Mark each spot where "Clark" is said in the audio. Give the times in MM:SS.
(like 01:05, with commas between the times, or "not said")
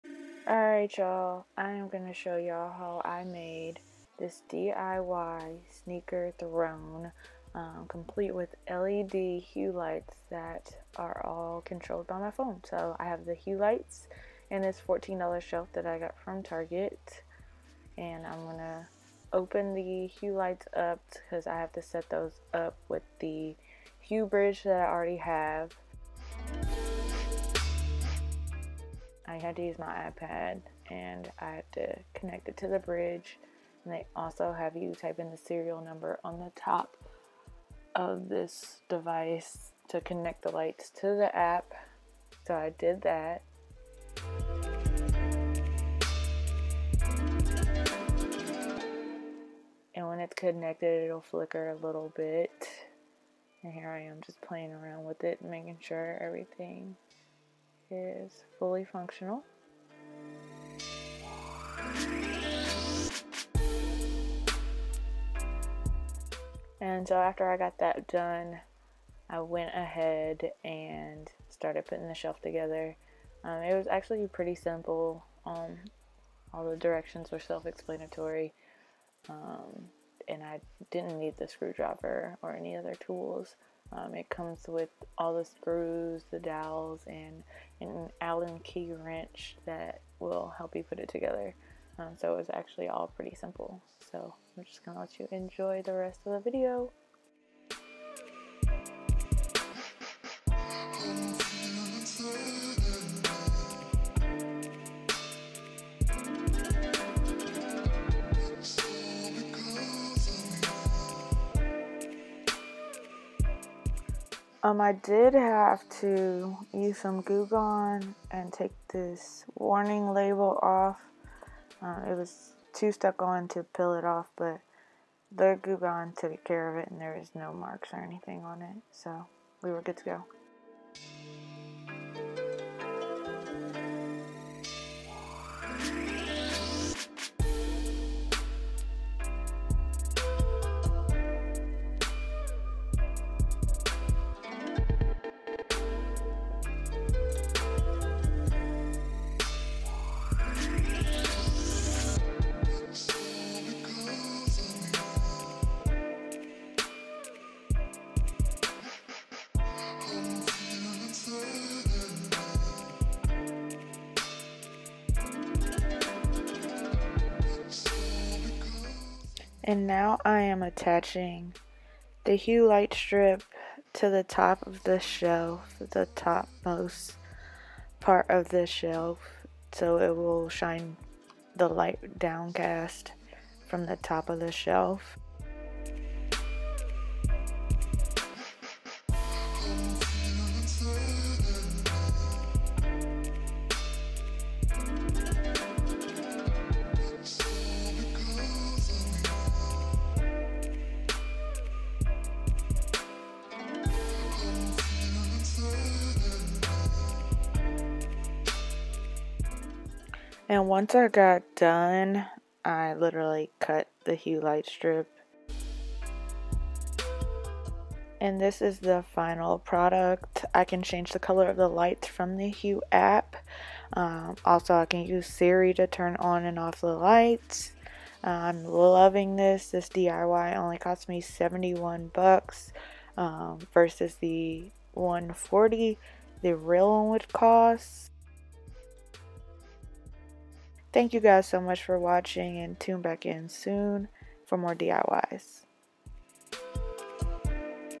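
not said.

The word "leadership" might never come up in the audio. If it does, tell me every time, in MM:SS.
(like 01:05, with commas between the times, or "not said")
not said.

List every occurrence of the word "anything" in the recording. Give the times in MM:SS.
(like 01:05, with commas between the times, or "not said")
02:08.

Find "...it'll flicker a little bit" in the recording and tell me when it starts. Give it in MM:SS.
00:51.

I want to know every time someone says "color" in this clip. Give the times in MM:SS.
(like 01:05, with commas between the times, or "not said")
03:41.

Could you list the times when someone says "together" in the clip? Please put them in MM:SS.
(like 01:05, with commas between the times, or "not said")
01:12, 01:31.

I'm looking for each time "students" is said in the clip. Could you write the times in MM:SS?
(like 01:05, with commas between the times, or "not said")
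not said.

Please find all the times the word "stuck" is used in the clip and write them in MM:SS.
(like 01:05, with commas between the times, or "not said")
02:02.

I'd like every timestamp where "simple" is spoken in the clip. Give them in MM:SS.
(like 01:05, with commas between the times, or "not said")
01:14, 01:33.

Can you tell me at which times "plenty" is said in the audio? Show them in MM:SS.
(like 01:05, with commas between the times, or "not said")
not said.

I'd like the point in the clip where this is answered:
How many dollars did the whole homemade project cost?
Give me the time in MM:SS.
03:51.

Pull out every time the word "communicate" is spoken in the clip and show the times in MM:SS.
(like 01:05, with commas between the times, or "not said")
not said.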